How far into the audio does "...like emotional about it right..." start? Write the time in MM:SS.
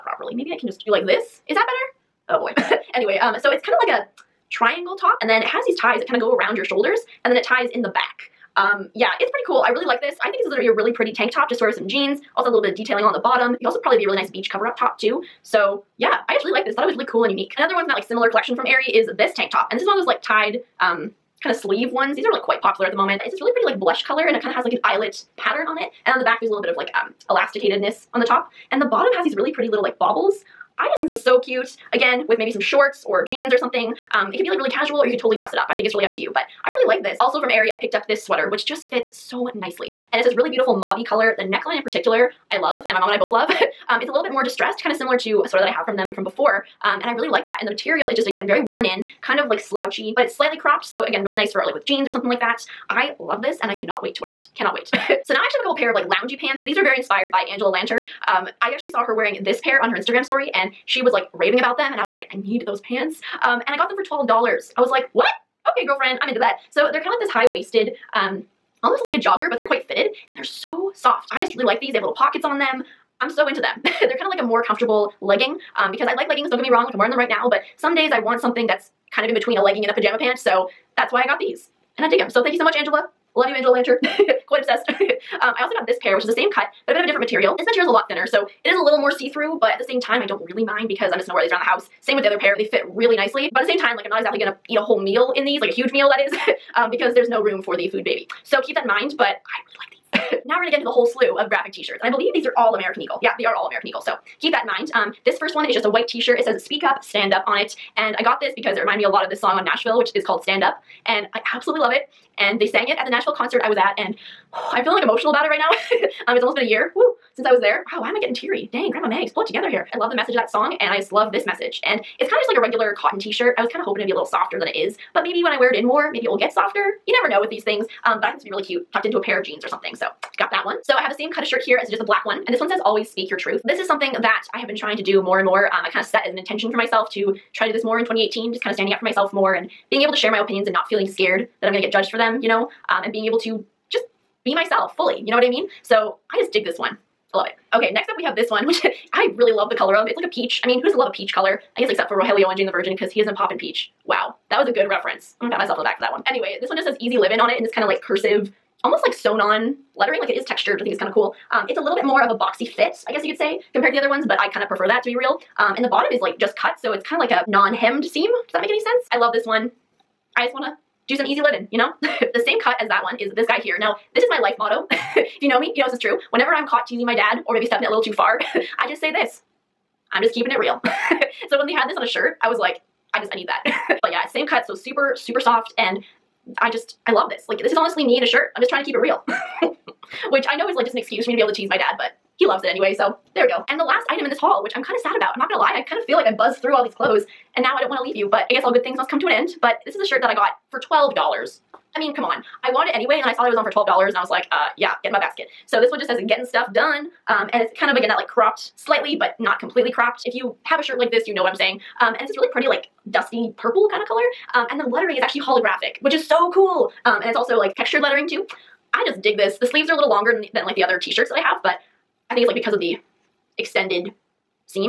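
01:54.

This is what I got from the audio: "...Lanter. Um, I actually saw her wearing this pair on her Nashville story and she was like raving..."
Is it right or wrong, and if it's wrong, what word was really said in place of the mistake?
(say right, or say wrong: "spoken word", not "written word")
wrong: "Instagram", not "Nashville".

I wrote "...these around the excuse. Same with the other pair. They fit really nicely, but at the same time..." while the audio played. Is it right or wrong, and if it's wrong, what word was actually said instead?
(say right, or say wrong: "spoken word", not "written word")
wrong: "house", not "excuse".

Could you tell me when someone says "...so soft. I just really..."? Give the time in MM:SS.
01:10.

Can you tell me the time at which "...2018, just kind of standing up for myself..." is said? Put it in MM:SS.
02:18.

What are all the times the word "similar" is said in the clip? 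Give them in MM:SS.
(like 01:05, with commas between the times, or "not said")
00:18, 00:44.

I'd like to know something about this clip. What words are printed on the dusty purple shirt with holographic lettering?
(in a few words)
Getting stuff done.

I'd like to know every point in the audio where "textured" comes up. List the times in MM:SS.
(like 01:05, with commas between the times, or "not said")
02:40, 03:37.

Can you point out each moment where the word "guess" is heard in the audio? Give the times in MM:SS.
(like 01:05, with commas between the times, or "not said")
02:31, 02:43, 03:18.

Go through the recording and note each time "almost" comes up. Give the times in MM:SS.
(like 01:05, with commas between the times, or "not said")
01:08, 01:56, 02:38.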